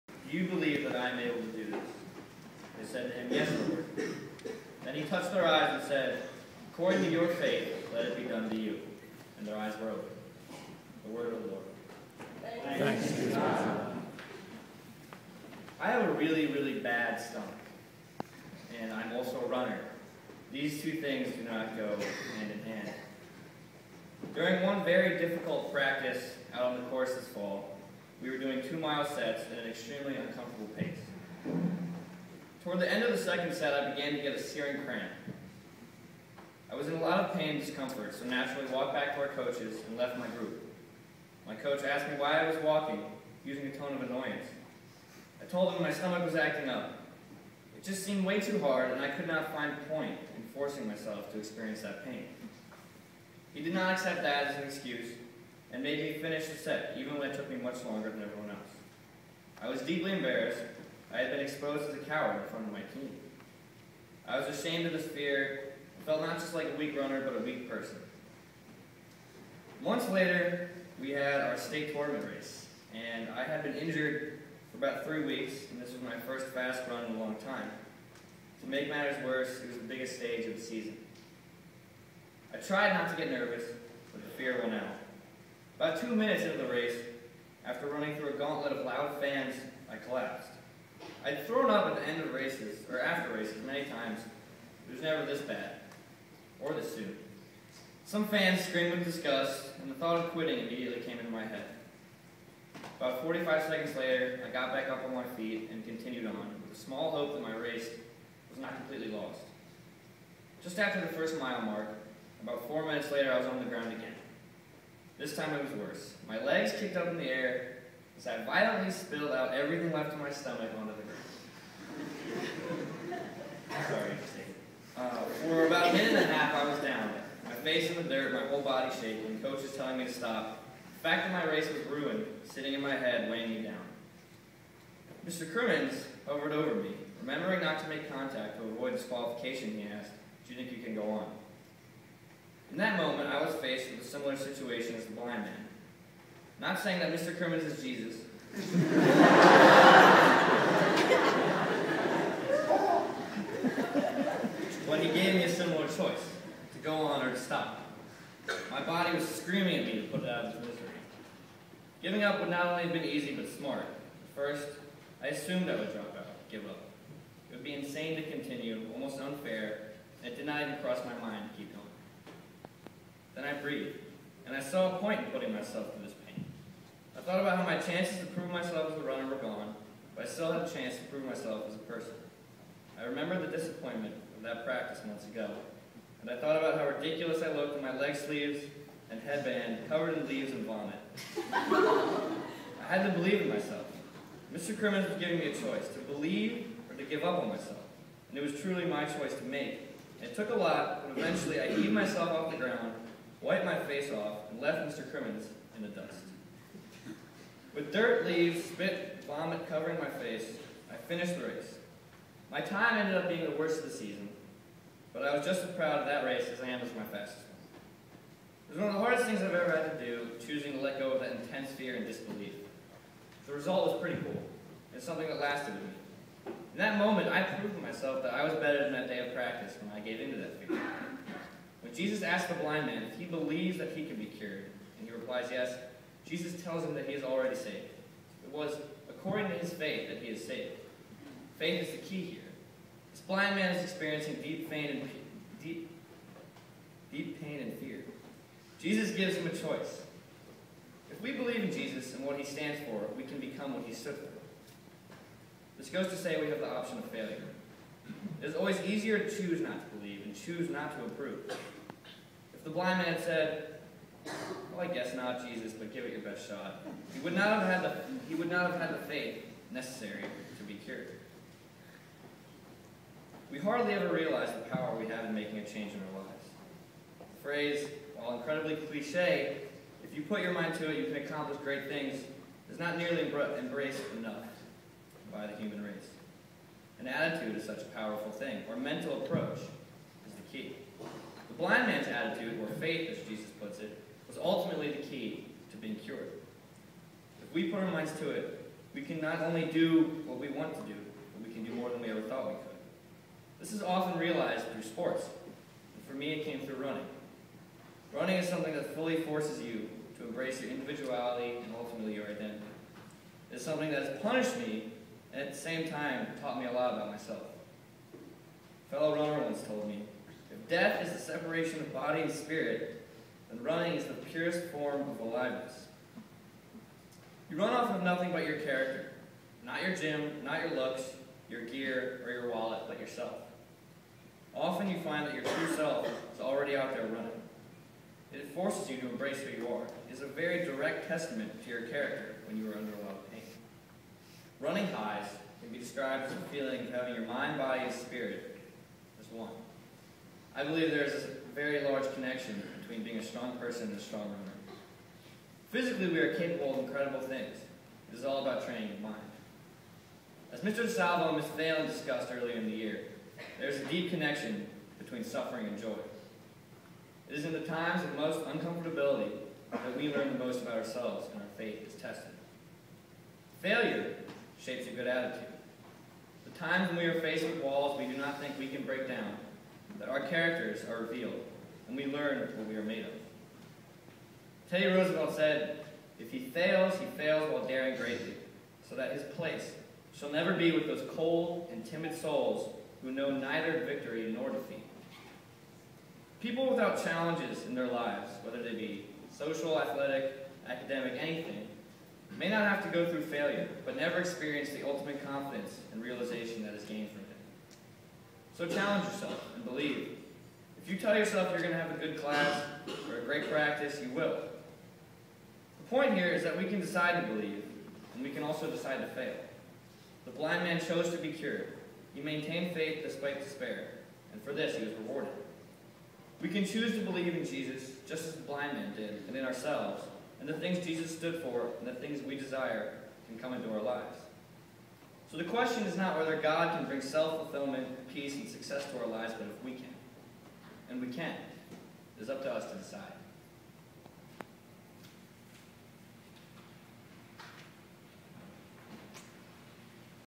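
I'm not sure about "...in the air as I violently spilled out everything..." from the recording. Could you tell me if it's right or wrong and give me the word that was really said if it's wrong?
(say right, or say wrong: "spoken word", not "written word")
right.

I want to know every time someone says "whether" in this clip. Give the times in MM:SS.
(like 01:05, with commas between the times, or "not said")
06:38, 07:16.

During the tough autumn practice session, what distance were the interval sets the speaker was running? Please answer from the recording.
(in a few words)
2 miles.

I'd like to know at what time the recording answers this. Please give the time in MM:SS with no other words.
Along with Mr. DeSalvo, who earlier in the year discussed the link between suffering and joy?
06:01.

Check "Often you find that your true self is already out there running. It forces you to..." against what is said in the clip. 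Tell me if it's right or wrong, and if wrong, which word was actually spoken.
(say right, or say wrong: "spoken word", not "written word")
right.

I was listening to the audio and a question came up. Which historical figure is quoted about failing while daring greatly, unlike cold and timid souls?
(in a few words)
Teddy Roosevelt.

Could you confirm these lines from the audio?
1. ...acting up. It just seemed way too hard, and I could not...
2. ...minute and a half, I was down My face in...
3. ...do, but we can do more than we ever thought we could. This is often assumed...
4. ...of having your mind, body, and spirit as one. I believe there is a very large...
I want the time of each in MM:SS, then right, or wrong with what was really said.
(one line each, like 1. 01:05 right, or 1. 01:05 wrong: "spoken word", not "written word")
1. 00:46 right
2. 02:05 right
3. 05:00 wrong: "realized", not "assumed"
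4. 05:46 right.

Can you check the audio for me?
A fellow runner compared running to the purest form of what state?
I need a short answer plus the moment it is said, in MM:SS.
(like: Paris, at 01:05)
aliveness, at 05:25.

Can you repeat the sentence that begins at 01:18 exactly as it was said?
To make matters worse, it was the biggest stage of the season.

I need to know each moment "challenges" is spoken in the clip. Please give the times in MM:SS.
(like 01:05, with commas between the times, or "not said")
06:37, 06:48.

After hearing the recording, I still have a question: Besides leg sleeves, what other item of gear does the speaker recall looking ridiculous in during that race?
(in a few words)
headband.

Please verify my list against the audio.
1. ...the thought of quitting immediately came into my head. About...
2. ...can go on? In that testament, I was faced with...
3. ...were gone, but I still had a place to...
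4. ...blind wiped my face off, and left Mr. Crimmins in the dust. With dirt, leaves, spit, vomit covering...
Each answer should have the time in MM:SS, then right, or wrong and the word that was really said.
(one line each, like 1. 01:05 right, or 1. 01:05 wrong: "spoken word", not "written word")
1. 01:39 right
2. 02:20 wrong: "moment", not "testament"
3. 02:59 wrong: "chance", not "place"
4. 03:22 wrong: "ground", not "blind".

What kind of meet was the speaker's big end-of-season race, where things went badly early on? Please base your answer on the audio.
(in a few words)
state tournament.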